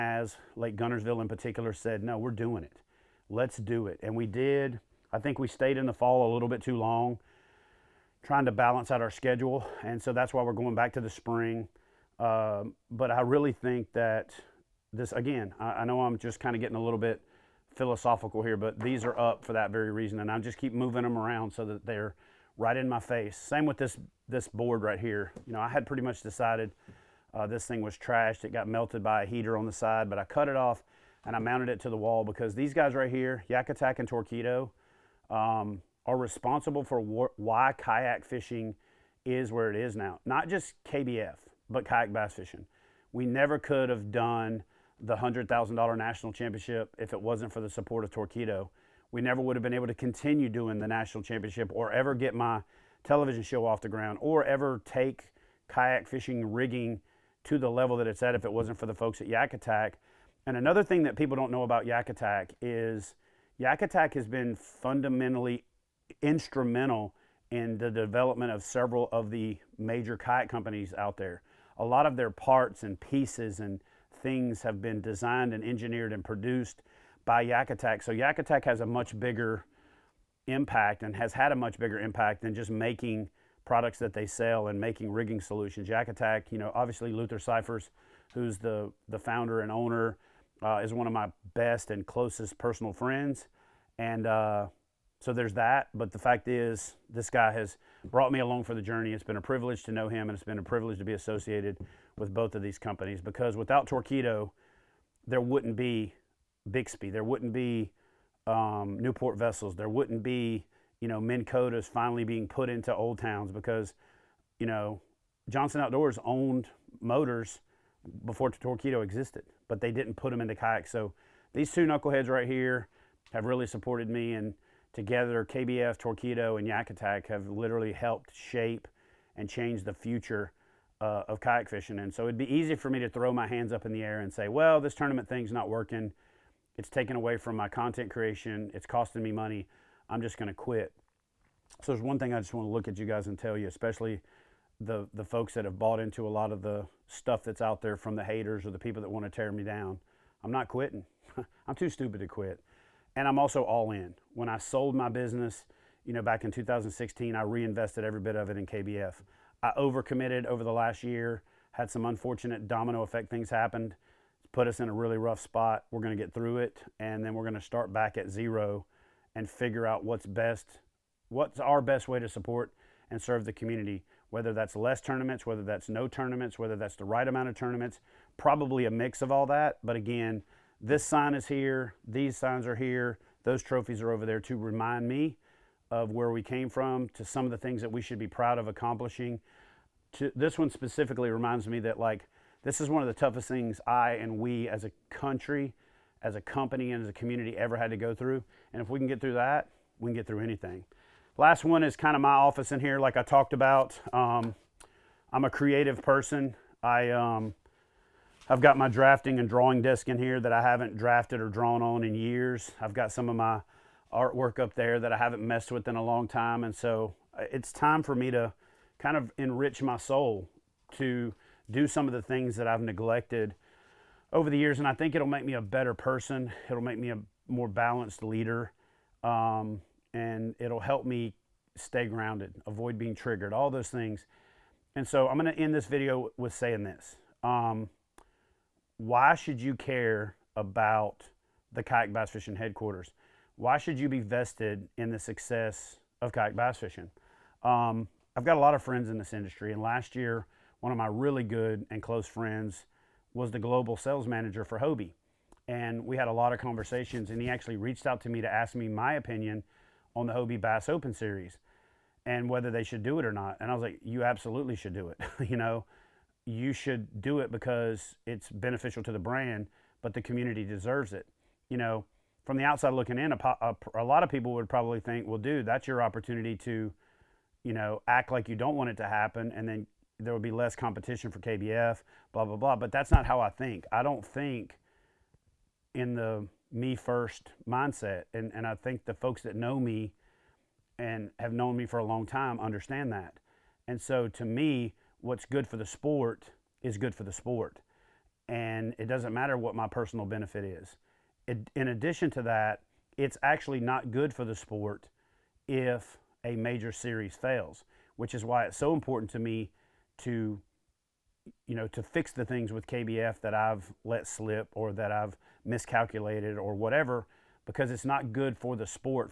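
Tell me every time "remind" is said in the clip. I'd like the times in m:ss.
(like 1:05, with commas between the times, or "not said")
3:04, 3:11.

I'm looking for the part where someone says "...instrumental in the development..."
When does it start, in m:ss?
1:06.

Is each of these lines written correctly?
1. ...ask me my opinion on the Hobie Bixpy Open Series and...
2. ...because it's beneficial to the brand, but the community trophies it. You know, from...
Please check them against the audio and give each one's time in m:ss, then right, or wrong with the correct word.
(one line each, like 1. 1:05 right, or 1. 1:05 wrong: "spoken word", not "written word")
1. 4:18 wrong: "Bass", not "Bixpy"
2. 4:27 wrong: "deserves", not "trophies".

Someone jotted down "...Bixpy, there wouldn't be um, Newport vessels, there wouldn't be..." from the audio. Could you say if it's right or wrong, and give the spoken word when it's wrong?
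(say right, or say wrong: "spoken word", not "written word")
right.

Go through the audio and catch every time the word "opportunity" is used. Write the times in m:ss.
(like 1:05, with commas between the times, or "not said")
4:36.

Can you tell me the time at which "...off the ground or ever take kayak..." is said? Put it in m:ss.
0:53.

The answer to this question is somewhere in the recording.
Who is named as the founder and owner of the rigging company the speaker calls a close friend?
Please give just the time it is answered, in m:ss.
1:27.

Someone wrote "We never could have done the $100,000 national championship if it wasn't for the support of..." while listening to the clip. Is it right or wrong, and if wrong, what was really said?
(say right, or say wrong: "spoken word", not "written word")
right.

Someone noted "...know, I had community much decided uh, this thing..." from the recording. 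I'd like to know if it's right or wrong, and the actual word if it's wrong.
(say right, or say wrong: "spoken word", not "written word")
wrong: "pretty", not "community".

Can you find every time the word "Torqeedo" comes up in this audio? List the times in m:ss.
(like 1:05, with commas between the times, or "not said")
0:34, 0:48, 1:43, 1:58, 2:05.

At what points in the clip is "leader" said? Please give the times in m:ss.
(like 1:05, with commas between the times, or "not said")
3:48.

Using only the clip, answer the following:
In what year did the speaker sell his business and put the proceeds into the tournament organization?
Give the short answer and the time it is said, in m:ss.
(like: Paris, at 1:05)
2016, at 2:36.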